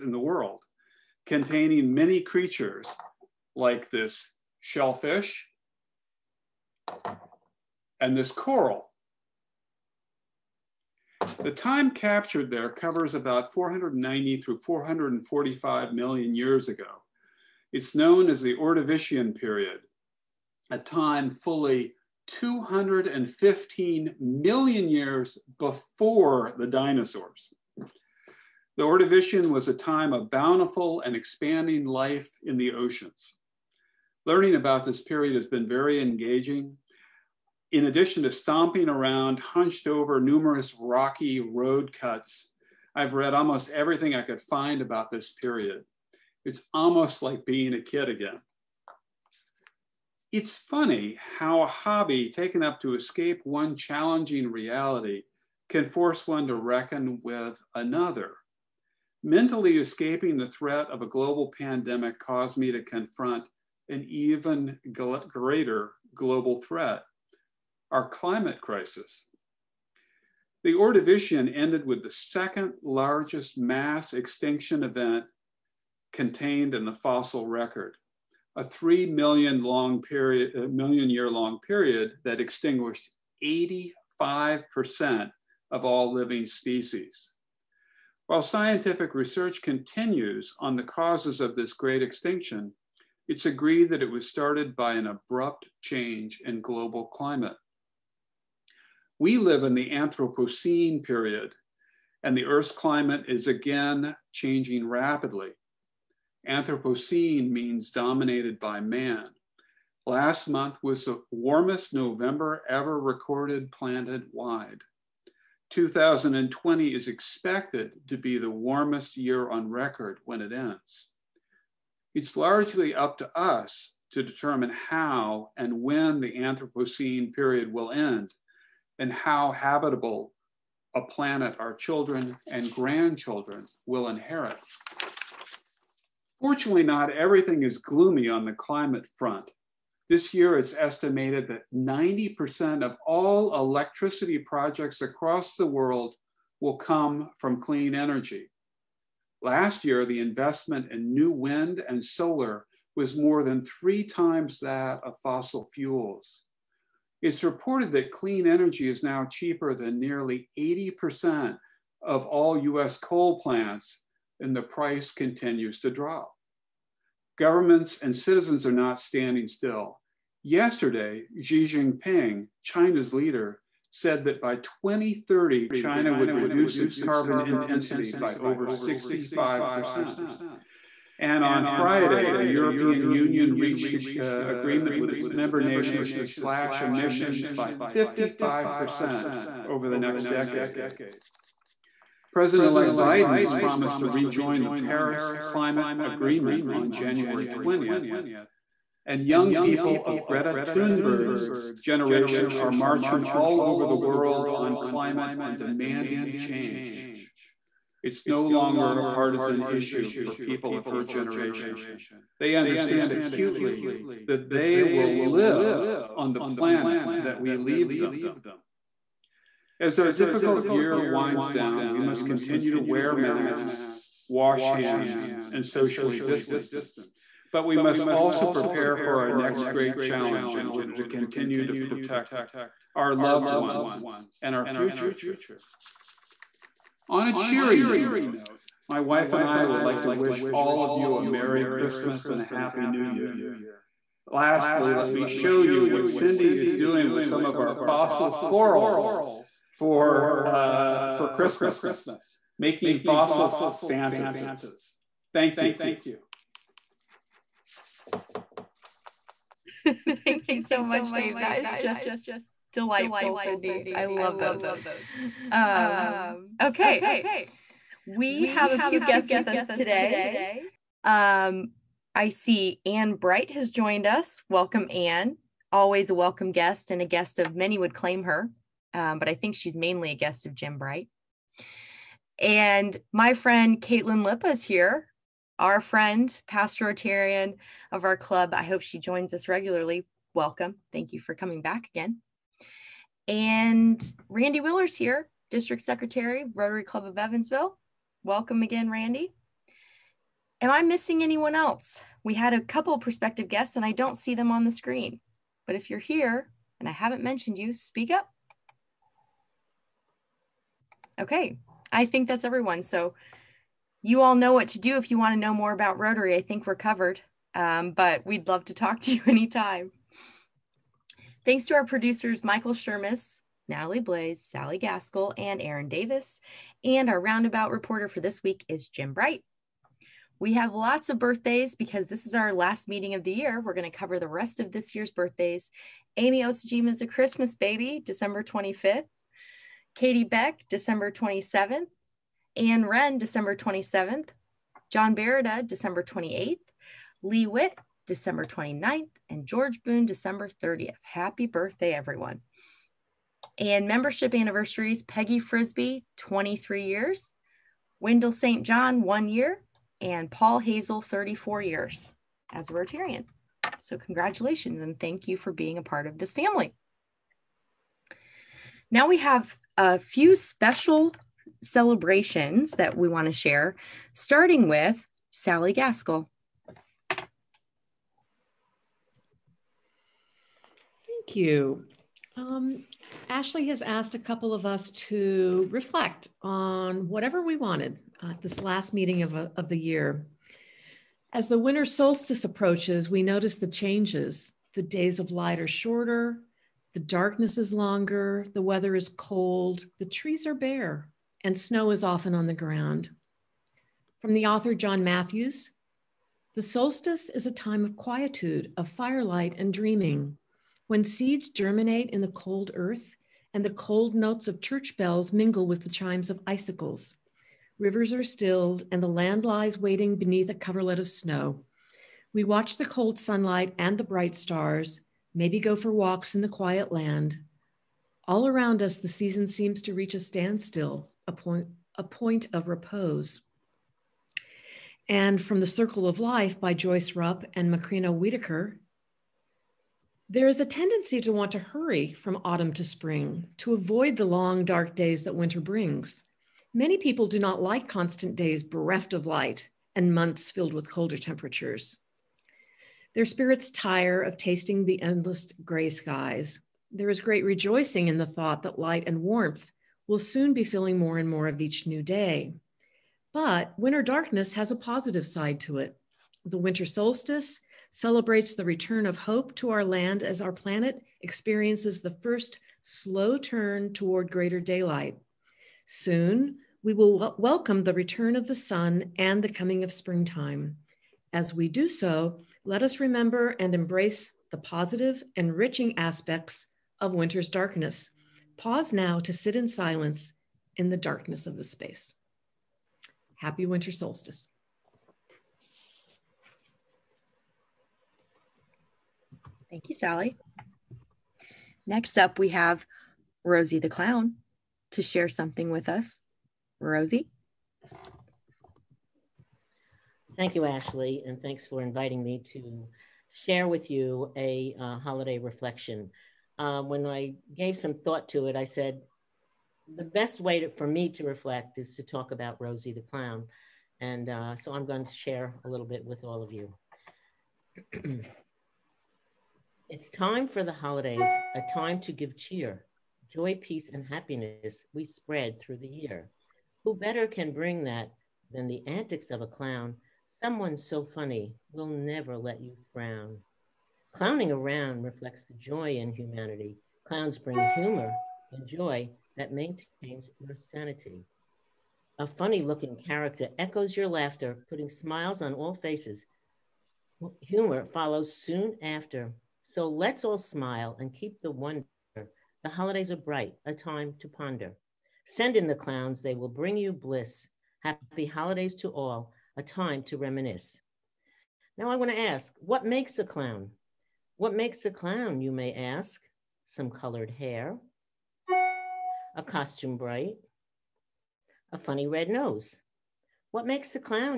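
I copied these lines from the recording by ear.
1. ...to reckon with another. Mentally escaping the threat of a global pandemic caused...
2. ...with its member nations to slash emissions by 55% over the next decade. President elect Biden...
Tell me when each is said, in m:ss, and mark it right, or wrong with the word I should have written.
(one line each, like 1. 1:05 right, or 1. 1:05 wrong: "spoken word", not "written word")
1. 0:56 right
2. 3:04 right.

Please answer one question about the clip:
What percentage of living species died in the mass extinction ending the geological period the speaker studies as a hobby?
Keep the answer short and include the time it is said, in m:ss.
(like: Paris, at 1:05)
85%, at 1:23.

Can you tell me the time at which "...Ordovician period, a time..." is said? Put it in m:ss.
0:18.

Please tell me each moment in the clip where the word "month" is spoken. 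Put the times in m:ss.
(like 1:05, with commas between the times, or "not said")
1:50, 7:30.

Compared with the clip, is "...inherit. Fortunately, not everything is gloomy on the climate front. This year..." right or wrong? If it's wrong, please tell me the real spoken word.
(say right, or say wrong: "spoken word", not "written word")
right.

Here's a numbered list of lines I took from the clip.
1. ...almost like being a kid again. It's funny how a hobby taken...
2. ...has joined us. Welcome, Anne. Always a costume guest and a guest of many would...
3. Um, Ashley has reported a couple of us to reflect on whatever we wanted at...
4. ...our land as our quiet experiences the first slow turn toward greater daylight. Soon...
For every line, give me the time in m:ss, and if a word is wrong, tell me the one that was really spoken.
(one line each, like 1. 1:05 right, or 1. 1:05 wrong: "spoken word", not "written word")
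1. 0:46 right
2. 4:33 wrong: "welcome", not "costume"
3. 6:22 wrong: "asked", not "reported"
4. 7:49 wrong: "planet", not "quiet".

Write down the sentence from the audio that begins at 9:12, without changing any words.
A funny looking character echoes your laughter, putting smiles on all faces.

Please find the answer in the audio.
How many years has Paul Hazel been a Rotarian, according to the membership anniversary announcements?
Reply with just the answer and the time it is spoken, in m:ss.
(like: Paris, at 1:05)
34 years, at 6:01.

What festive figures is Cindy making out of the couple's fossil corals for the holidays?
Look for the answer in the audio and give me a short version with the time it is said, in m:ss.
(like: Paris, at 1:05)
fossil Santas, at 4:12.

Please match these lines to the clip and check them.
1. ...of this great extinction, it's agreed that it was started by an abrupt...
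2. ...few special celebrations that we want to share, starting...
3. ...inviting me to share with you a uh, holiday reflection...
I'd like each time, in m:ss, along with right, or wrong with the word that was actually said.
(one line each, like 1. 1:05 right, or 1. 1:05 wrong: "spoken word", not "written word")
1. 1:31 right
2. 6:09 right
3. 8:31 right.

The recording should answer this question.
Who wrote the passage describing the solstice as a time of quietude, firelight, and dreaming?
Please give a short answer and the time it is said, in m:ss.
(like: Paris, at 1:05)
John Matthews, at 6:44.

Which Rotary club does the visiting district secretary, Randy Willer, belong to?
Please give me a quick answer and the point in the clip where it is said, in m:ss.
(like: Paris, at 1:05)
Evansville, at 4:57.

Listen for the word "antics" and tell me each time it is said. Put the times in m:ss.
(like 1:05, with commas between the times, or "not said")
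8:58.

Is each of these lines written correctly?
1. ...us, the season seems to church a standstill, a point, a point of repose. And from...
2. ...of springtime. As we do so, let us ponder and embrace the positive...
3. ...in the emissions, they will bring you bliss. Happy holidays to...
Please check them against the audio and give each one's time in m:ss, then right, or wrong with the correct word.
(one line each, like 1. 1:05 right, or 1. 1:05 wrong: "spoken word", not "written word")
1. 7:08 wrong: "reach", not "church"
2. 7:59 wrong: "remember", not "ponder"
3. 9:25 wrong: "clowns", not "emissions".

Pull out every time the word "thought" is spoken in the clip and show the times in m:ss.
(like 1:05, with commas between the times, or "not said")
7:38, 8:37.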